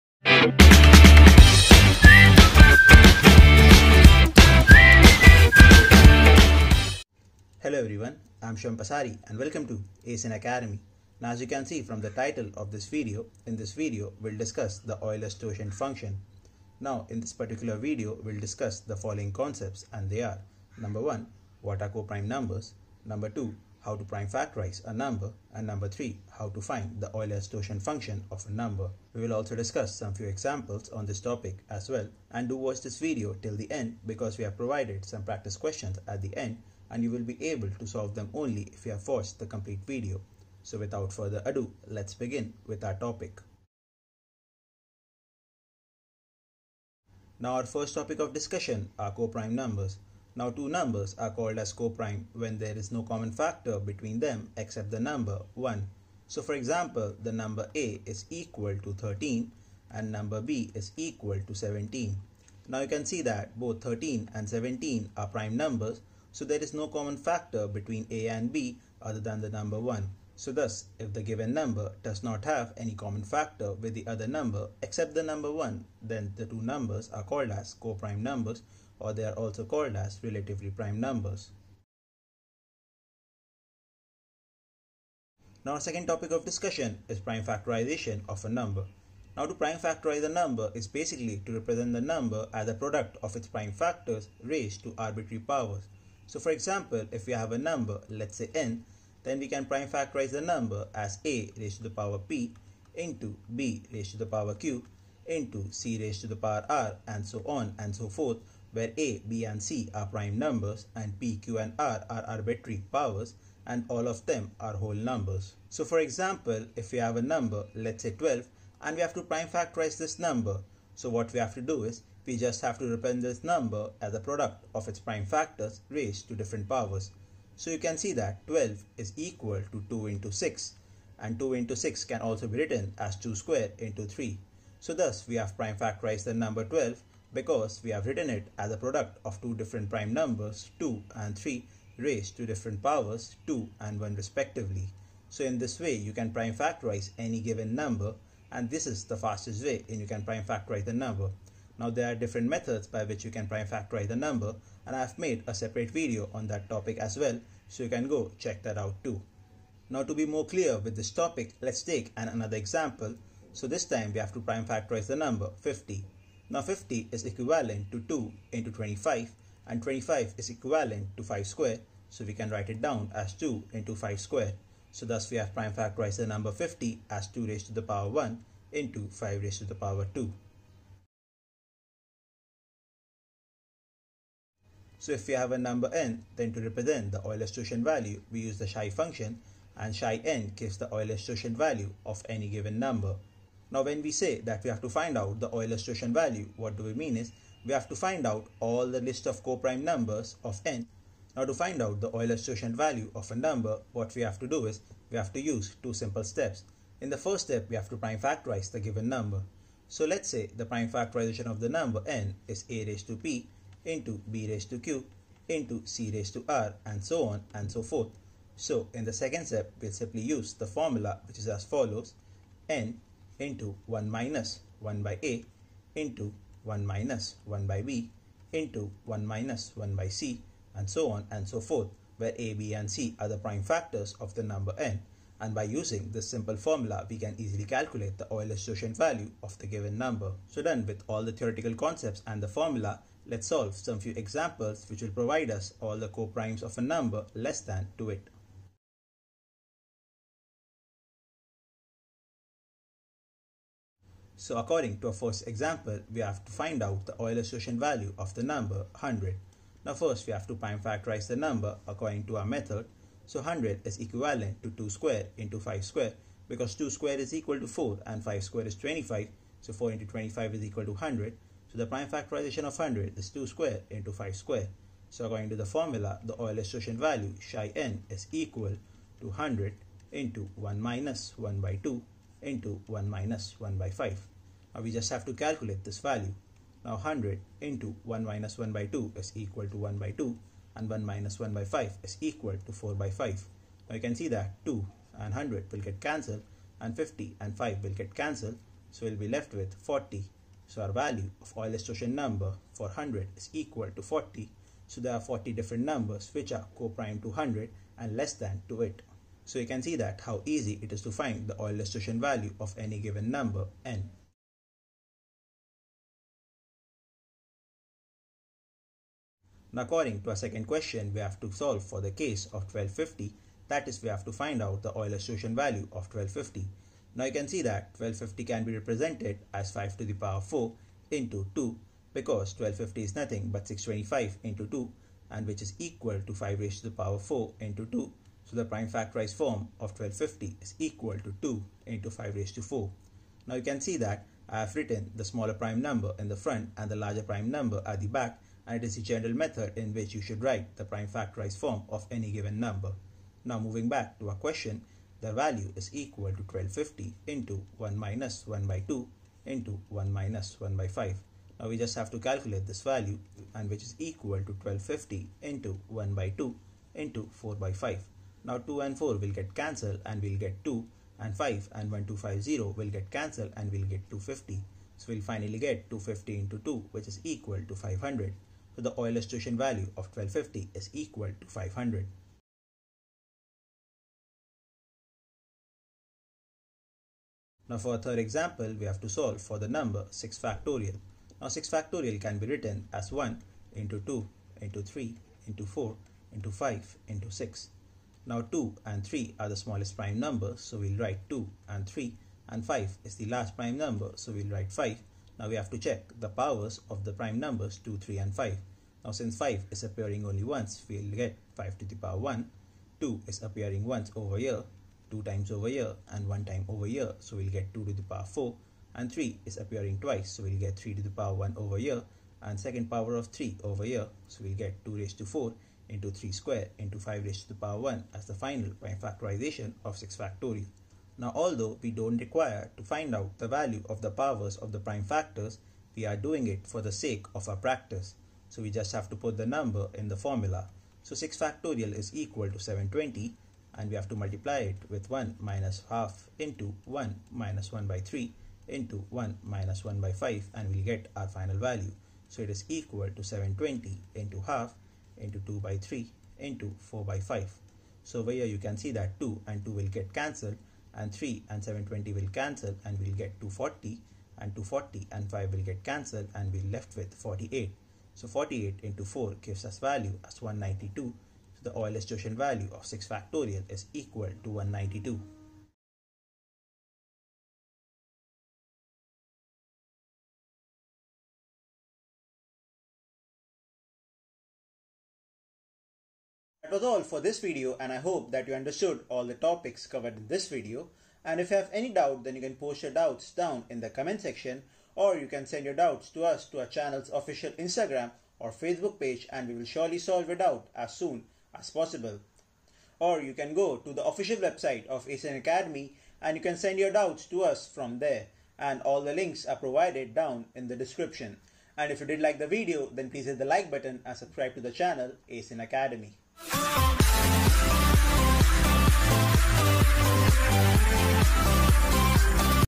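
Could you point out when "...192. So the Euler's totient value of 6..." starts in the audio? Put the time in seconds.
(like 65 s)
470 s.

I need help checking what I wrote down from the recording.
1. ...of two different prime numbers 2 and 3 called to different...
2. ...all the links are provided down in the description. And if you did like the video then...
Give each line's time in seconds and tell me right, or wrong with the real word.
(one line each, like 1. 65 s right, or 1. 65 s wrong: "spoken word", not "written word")
1. 139 s wrong: "raised", not "called"
2. 508 s right.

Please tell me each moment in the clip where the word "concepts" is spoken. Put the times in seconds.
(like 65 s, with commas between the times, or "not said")
19 s, 241 s.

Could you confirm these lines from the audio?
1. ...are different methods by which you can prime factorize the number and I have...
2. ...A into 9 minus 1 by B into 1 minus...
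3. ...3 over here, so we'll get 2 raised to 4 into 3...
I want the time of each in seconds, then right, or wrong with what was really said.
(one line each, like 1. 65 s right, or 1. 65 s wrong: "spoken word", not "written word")
1. 152 s right
2. 225 s wrong: "1", not "9"
3. 423 s right.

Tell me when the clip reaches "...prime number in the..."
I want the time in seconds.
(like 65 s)
345 s.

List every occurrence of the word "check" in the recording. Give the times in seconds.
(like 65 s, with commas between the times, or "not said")
158 s, 405 s.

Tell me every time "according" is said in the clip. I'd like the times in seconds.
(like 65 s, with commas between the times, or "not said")
254 s, 261 s, 275 s, 319 s.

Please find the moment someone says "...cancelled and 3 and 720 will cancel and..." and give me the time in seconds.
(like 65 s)
460 s.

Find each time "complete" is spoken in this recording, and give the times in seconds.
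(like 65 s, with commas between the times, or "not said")
39 s.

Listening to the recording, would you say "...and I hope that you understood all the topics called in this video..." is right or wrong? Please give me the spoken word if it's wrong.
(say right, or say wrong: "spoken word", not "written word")
wrong: "covered", not "called".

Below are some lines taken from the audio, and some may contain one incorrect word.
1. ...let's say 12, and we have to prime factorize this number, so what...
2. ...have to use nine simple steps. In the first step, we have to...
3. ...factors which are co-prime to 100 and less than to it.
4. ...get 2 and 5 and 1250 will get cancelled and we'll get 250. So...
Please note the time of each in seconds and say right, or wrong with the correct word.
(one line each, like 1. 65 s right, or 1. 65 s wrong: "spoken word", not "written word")
1. 117 s right
2. 205 s wrong: "two", not "nine"
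3. 305 s wrong: "numbers", not "factors"
4. 370 s right.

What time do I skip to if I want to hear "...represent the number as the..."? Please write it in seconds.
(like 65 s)
91 s.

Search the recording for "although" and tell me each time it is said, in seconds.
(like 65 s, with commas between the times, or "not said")
431 s.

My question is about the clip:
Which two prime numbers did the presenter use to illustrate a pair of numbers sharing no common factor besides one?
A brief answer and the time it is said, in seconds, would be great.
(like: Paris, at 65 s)
13 and 17, at 63 s.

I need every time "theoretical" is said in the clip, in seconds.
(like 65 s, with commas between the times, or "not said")
241 s.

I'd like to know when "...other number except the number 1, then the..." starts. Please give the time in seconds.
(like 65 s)
74 s.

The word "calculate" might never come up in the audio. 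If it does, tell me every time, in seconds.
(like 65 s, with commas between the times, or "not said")
237 s, 285 s, 362 s.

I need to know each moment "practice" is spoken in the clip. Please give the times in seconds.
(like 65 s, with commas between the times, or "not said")
35 s, 437 s.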